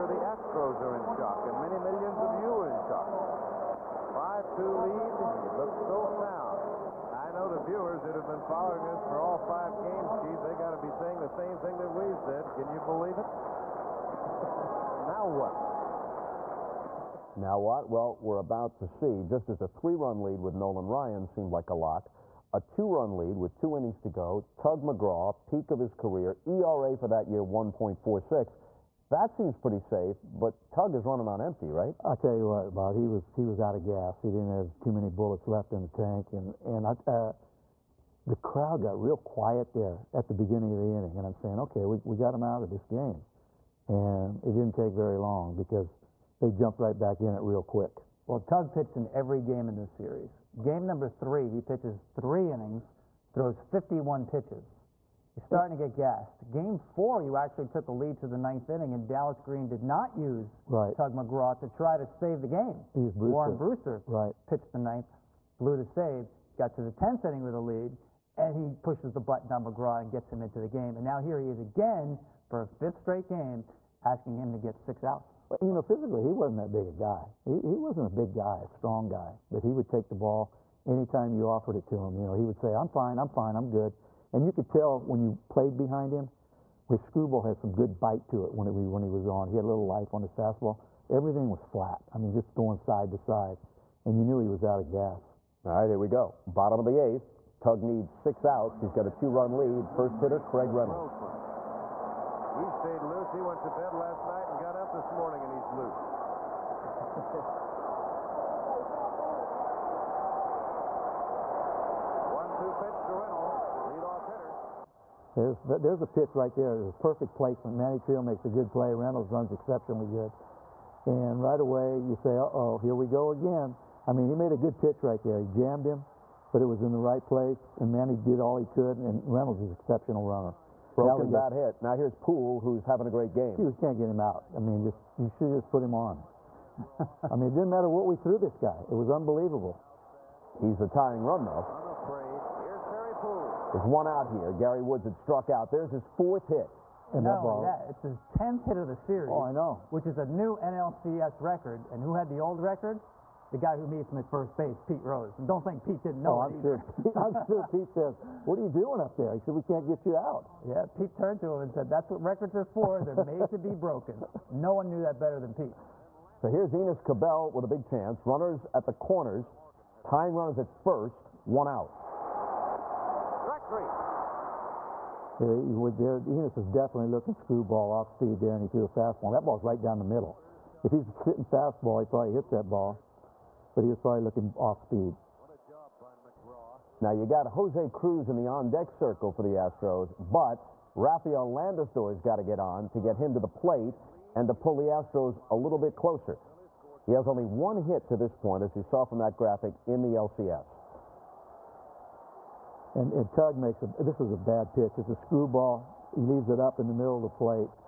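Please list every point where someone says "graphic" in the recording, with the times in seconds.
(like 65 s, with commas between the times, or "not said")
199 s.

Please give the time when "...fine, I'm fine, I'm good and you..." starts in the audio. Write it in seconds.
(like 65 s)
82 s.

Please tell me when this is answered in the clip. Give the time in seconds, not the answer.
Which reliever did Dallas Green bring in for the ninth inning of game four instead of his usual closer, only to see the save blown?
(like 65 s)
63 s.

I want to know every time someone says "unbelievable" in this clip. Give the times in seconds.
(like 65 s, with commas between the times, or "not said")
139 s.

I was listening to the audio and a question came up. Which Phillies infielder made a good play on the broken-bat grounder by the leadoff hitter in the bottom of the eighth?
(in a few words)
Manny Trillo.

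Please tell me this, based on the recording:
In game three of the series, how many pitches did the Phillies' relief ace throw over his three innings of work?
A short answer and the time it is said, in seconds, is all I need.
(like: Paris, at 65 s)
51, at 53 s.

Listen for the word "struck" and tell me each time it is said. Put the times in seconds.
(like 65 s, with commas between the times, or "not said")
145 s.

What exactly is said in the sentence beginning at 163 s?
They're made to be broken." No one knew that better than Pete.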